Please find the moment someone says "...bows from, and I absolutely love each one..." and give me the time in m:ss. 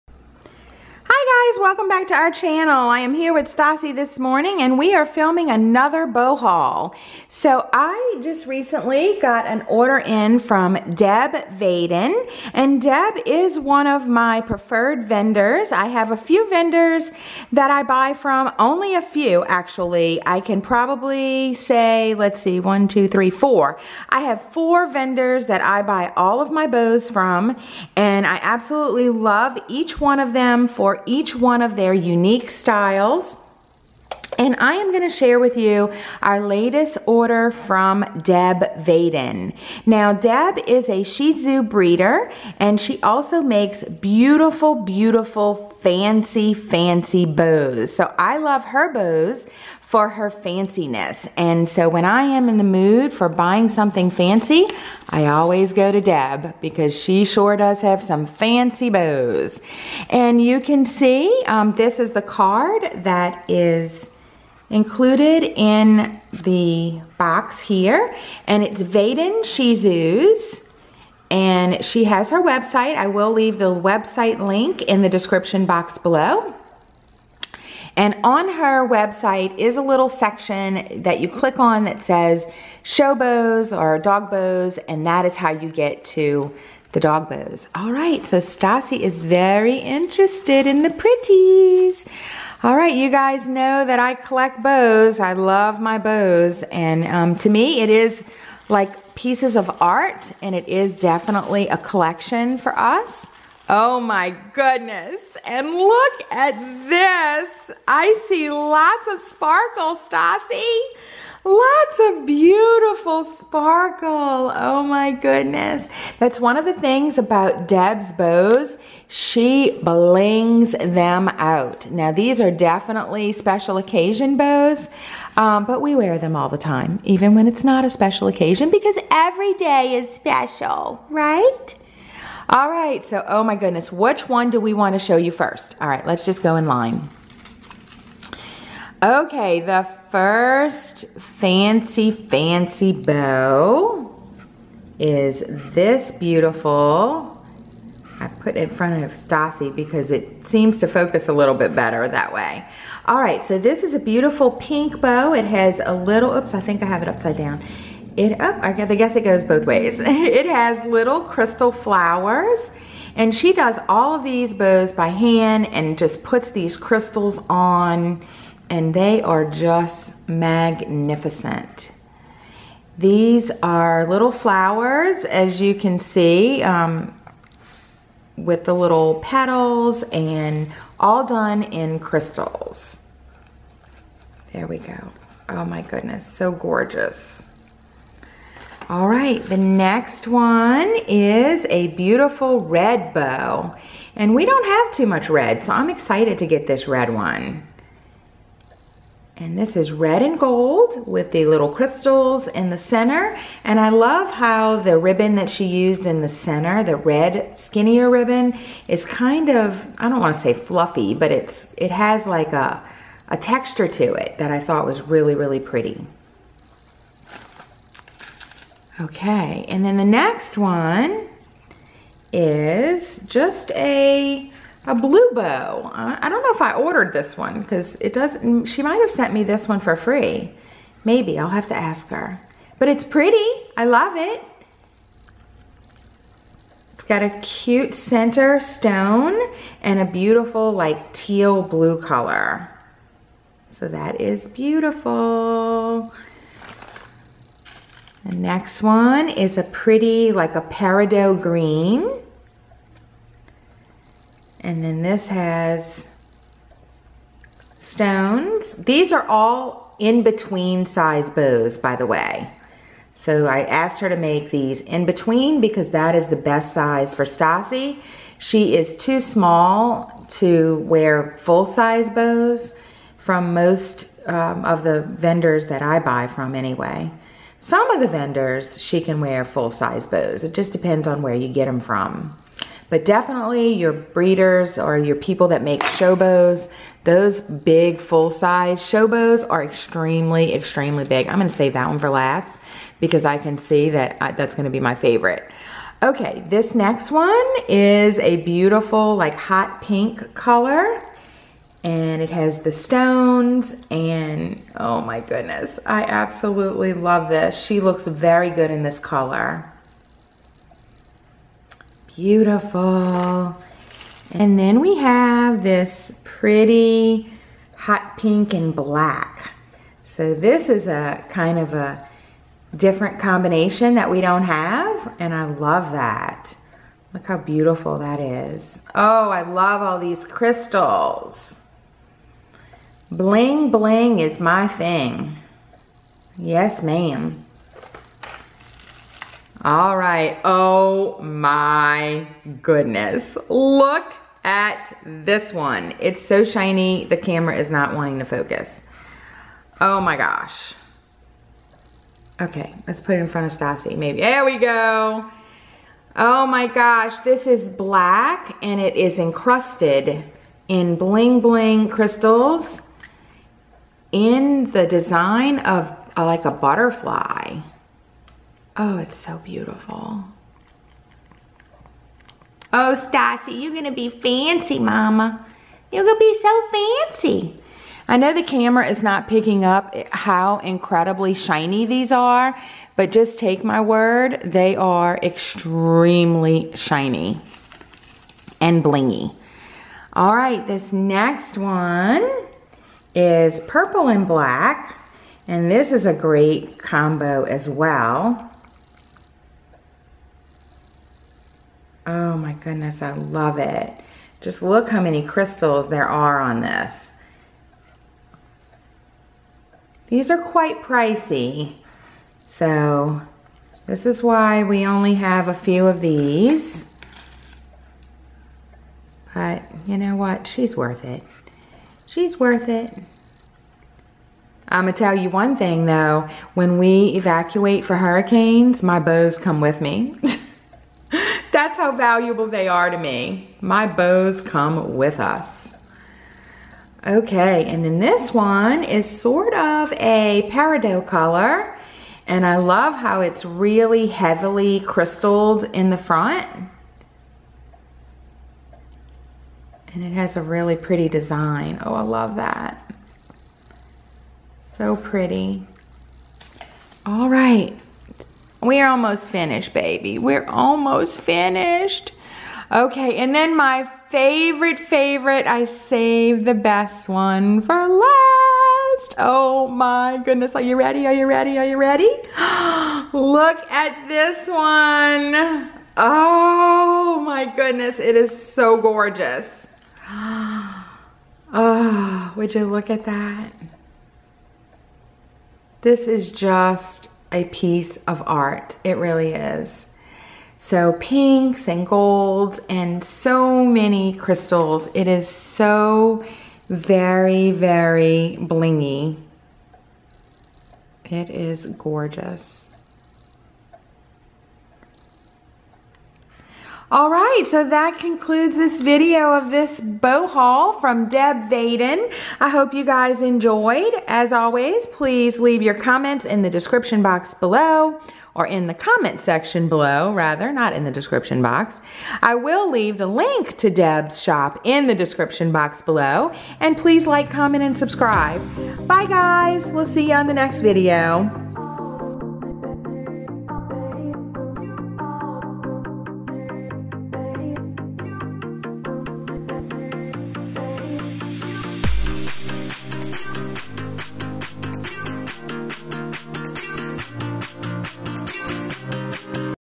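0:26.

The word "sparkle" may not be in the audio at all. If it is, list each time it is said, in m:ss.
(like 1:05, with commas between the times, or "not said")
1:49, 1:53.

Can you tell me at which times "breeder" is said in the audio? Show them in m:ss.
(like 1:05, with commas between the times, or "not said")
0:41, 4:43.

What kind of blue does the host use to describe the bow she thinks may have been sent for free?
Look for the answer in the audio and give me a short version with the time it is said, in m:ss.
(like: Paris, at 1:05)
Teal blue, at 4:01.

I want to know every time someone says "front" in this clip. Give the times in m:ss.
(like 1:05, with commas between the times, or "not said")
2:28, 5:53, 7:25.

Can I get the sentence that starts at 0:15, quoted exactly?
I have a few vendors that I buy from.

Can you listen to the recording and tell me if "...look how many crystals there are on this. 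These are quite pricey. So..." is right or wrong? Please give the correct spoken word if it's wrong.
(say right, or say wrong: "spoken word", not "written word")
right.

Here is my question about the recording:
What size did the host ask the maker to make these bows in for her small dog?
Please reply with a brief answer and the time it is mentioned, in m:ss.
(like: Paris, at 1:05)
In between size, at 4:19.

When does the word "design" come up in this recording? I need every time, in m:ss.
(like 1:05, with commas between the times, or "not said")
6:04, 7:31.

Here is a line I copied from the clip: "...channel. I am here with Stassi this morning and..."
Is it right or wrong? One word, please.
right.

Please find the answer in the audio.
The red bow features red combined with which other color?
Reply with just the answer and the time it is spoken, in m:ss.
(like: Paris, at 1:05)
Gold, at 3:19.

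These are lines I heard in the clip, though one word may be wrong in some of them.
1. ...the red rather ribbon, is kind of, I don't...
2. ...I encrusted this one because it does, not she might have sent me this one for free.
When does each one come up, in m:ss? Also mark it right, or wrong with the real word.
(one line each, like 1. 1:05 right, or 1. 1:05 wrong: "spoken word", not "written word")
1. 3:26 wrong: "skinnier", not "rather"
2. 3:46 wrong: "ordered", not "encrusted".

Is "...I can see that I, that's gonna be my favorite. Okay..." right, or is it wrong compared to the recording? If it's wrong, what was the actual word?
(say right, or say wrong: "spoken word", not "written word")
right.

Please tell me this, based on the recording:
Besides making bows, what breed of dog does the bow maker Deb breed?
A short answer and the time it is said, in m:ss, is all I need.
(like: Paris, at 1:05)
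Shih Tzu, at 0:41.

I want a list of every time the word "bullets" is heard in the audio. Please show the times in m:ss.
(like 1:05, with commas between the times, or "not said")
not said.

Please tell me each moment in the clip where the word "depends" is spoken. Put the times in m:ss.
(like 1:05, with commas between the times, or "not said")
4:40.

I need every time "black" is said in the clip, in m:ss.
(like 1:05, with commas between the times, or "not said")
5:18, 5:57, 6:34.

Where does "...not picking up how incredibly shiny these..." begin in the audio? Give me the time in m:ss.
6:19.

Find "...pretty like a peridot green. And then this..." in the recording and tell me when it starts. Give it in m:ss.
4:09.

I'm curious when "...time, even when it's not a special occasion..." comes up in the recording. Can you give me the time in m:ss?
2:06.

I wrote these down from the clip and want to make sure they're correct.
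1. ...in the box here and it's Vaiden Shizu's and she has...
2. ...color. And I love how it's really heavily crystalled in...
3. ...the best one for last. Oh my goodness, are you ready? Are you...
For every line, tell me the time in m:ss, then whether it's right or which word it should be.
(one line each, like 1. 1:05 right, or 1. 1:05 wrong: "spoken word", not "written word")
1. 1:05 right
2. 7:21 right
3. 7:46 right.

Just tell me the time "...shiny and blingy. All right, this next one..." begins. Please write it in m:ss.
6:26.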